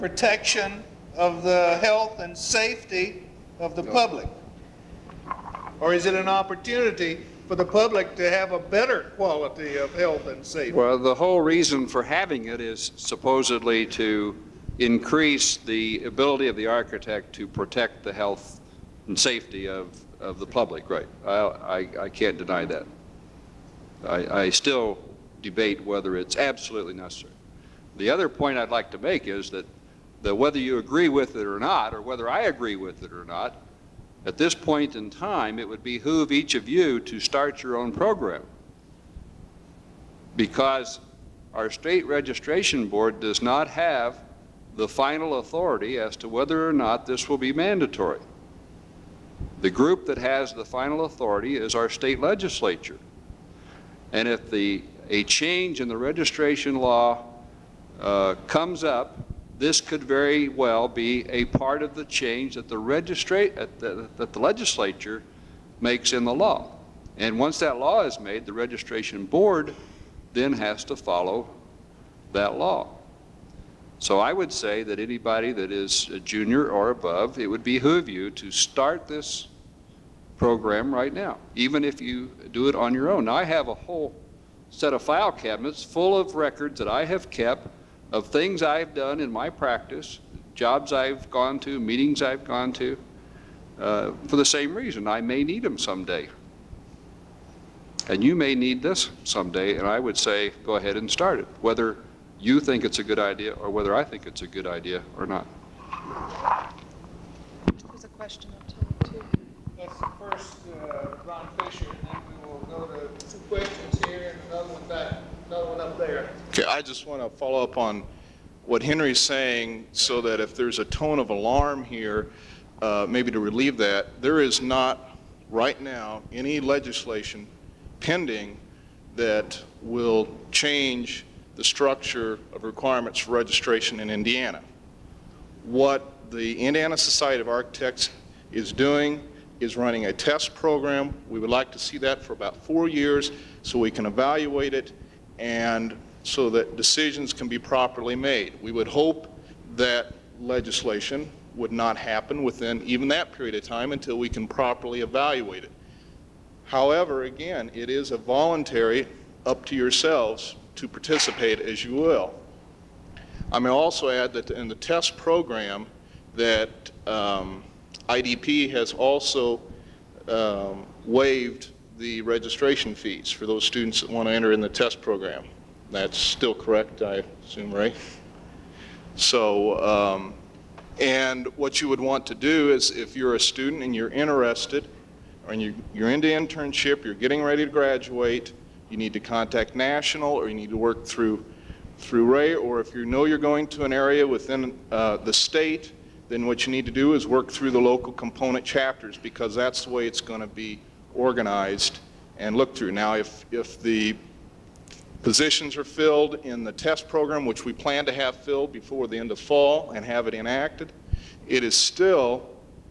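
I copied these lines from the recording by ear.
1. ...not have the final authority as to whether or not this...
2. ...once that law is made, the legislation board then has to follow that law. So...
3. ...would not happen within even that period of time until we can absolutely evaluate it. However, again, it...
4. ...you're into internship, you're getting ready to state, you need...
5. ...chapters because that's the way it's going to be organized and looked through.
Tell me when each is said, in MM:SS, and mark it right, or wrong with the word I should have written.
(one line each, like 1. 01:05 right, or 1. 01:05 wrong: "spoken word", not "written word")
1. 00:43 right
2. 01:07 wrong: "registration", not "legislation"
3. 02:31 wrong: "properly", not "absolutely"
4. 03:05 wrong: "graduate", not "state"
5. 03:18 right.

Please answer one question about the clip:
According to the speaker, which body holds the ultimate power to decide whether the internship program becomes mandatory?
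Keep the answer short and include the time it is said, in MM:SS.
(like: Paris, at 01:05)
State legislature, at 00:51.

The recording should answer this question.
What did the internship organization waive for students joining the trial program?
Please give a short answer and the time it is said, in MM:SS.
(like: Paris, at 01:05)
Registration fees, at 02:52.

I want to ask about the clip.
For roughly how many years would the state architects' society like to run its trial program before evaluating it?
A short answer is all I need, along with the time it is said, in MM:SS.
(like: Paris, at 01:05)
4 years, at 02:22.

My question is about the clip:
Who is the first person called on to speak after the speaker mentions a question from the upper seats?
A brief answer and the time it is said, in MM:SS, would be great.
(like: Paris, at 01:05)
Ron Fisher, at 01:51.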